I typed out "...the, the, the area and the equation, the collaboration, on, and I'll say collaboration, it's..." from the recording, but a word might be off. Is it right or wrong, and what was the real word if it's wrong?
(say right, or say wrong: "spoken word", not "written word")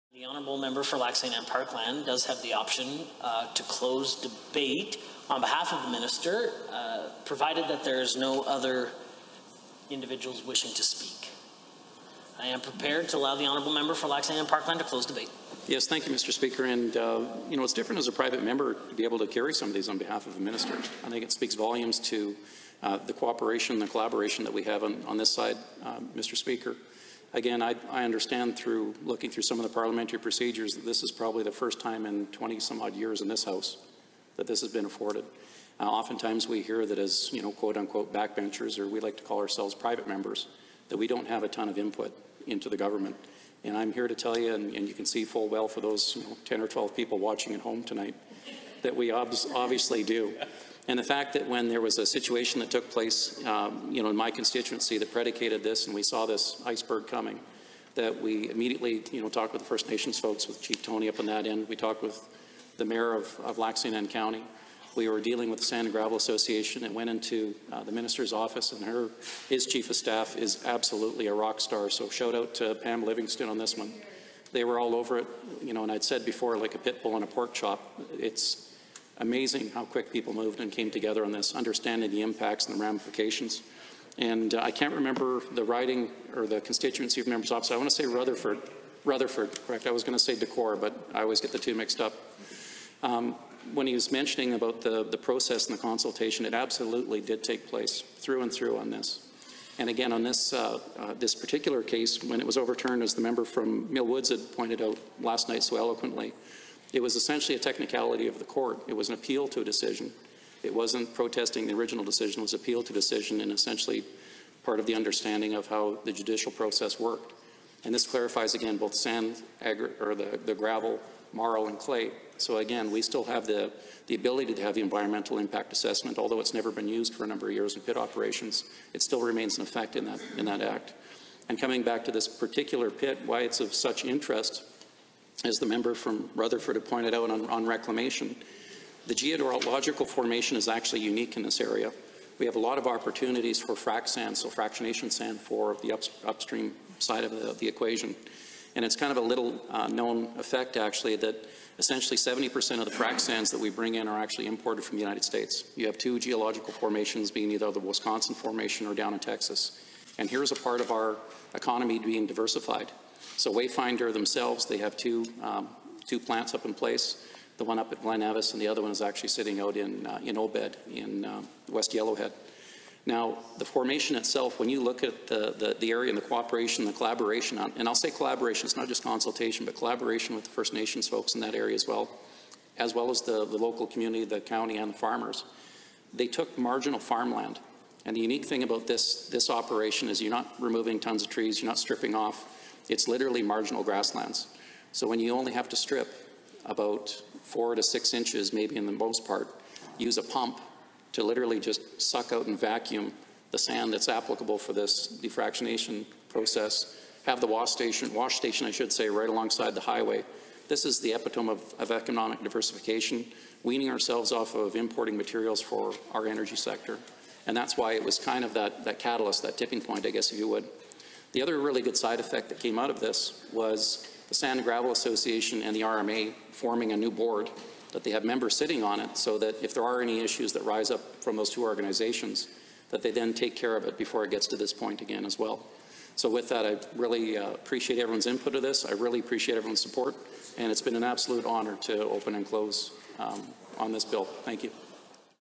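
wrong: "cooperation", not "equation".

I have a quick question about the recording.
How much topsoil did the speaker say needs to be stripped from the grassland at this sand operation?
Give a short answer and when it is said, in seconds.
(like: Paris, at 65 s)
4 to 6 inches, at 197 s.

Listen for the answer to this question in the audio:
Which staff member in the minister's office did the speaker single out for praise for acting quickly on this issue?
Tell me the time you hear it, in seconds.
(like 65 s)
72 s.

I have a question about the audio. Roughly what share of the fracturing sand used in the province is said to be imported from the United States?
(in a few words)
70%.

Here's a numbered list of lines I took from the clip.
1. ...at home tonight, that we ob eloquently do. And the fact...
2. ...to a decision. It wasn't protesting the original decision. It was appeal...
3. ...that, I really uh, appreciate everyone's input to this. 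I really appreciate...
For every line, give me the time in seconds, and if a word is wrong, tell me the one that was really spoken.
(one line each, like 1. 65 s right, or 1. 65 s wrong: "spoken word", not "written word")
1. 47 s wrong: "obviously", not "eloquently"
2. 109 s right
3. 236 s right.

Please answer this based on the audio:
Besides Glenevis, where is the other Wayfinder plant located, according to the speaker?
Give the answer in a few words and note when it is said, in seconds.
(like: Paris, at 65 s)
Obed, at 170 s.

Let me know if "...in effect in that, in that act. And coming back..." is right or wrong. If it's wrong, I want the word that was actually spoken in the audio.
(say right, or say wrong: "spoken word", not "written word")
right.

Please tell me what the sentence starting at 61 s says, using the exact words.
We talked with the mayor of, of lac County.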